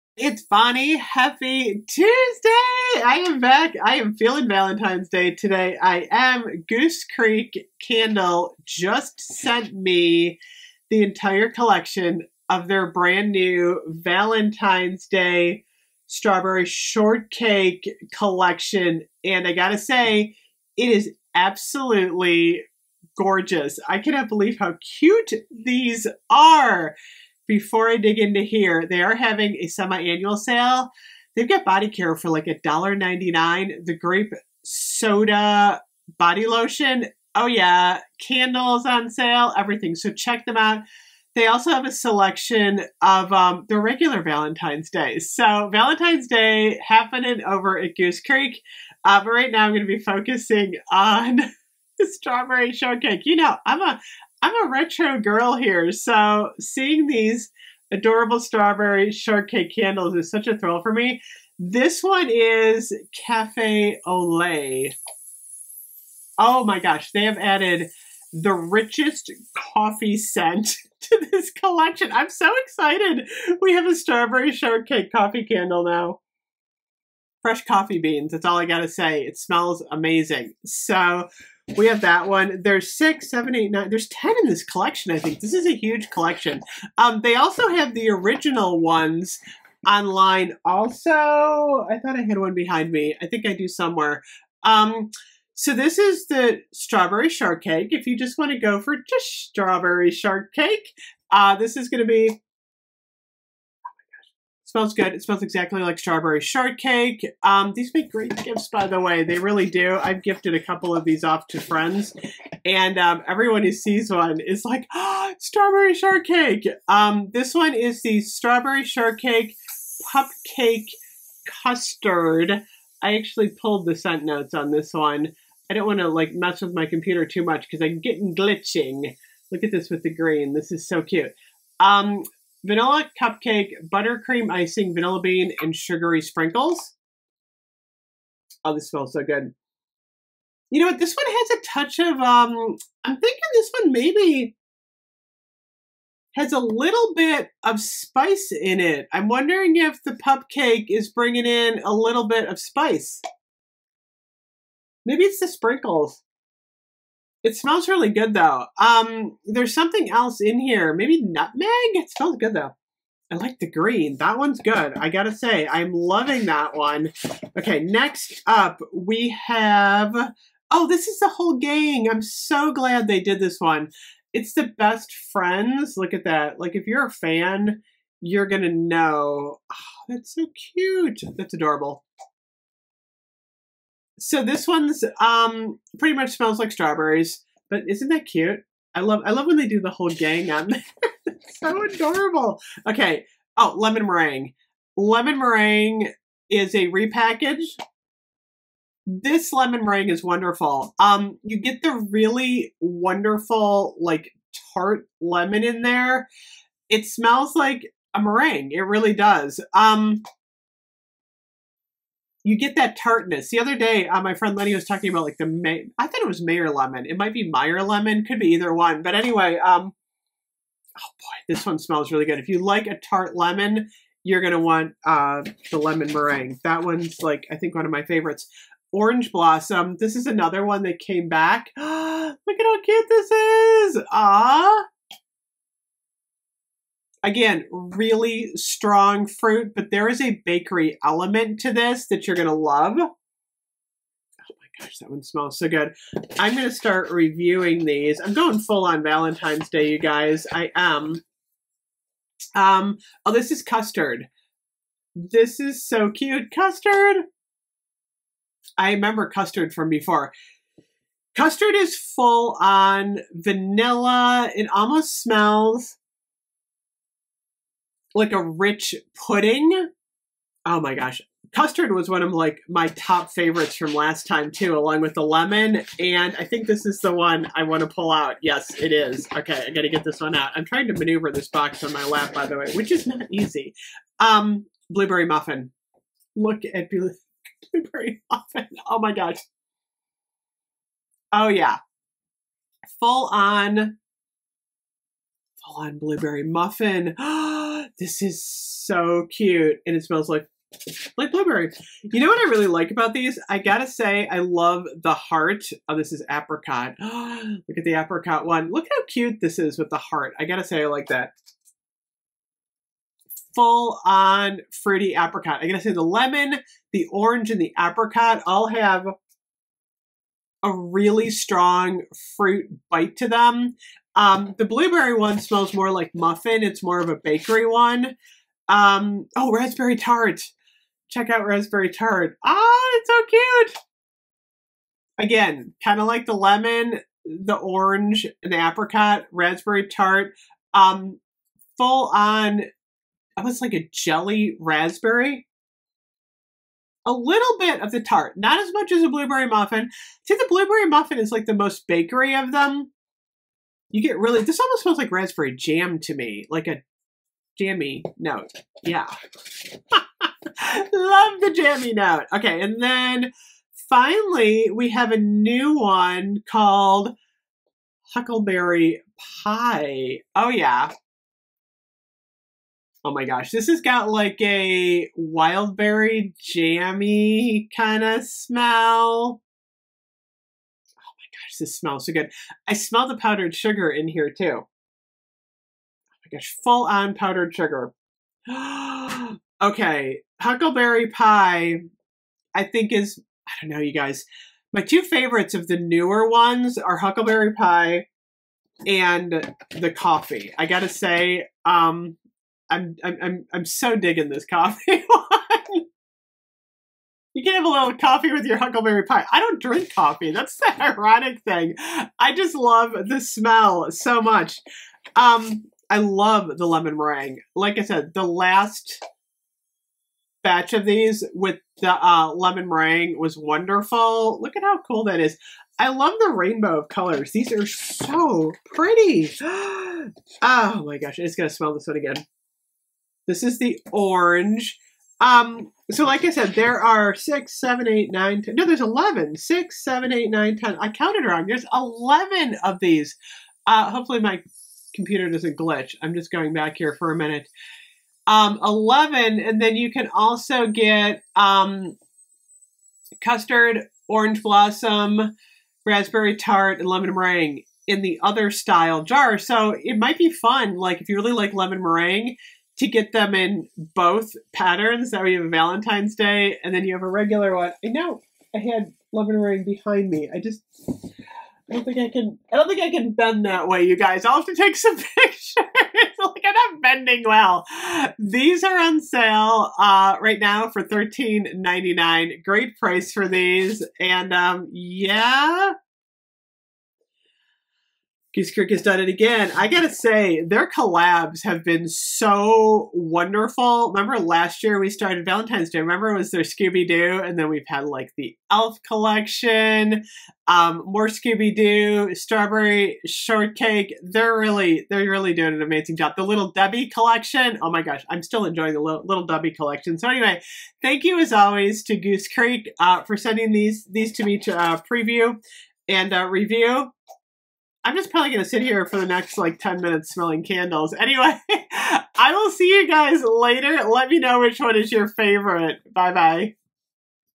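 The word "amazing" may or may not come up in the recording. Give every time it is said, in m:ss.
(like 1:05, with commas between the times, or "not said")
1:19, 8:25.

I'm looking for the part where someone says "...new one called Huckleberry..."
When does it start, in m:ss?
6:05.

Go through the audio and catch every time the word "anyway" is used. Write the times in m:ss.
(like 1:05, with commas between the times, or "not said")
3:39, 8:30, 8:40.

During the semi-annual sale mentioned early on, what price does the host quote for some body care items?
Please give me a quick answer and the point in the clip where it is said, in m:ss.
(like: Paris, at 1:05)
$1.99, at 0:32.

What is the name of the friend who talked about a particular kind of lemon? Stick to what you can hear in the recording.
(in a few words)
Lenny.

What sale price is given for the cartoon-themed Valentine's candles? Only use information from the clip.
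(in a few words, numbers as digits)
$13.99.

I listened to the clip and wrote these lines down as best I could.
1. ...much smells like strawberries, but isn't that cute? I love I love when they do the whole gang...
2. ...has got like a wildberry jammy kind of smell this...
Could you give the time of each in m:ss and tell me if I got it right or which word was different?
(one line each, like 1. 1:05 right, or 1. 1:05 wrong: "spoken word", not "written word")
1. 3:06 right
2. 6:13 right.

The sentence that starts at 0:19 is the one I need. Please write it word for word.
And I gotta say, it is absolutely gorgeous.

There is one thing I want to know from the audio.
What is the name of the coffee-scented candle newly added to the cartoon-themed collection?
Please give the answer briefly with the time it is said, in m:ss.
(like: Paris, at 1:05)
Cafe Ole, at 1:03.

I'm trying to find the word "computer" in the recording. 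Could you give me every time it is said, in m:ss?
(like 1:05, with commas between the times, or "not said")
2:06, 7:24.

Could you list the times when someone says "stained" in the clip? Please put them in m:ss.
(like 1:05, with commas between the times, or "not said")
not said.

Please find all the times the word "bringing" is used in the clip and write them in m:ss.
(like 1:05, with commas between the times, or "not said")
2:31.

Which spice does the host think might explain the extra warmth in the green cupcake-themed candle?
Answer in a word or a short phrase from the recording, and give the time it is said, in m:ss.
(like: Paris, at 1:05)
Nutmeg, at 2:41.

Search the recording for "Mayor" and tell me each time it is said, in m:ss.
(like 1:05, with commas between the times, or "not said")
3:36.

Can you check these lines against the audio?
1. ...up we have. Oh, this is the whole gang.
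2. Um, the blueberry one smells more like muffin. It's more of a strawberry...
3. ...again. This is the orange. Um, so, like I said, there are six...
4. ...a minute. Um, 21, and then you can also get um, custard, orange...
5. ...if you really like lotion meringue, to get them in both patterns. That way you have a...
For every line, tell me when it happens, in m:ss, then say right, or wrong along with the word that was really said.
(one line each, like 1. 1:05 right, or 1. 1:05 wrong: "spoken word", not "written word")
1. 2:48 right
2. 5:24 wrong: "bakery", not "strawberry"
3. 7:11 right
4. 7:27 wrong: "11", not "21"
5. 7:41 wrong: "lemon", not "lotion".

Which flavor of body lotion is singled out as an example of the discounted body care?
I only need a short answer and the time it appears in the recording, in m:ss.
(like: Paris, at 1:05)
Grape soda, at 0:33.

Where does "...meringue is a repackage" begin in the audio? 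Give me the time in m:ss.
3:15.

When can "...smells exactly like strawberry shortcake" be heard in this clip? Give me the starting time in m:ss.
1:45.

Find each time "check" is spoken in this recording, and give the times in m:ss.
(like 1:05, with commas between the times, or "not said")
0:40, 5:31.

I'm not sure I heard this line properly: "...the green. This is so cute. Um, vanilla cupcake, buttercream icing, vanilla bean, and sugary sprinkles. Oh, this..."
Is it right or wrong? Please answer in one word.
right.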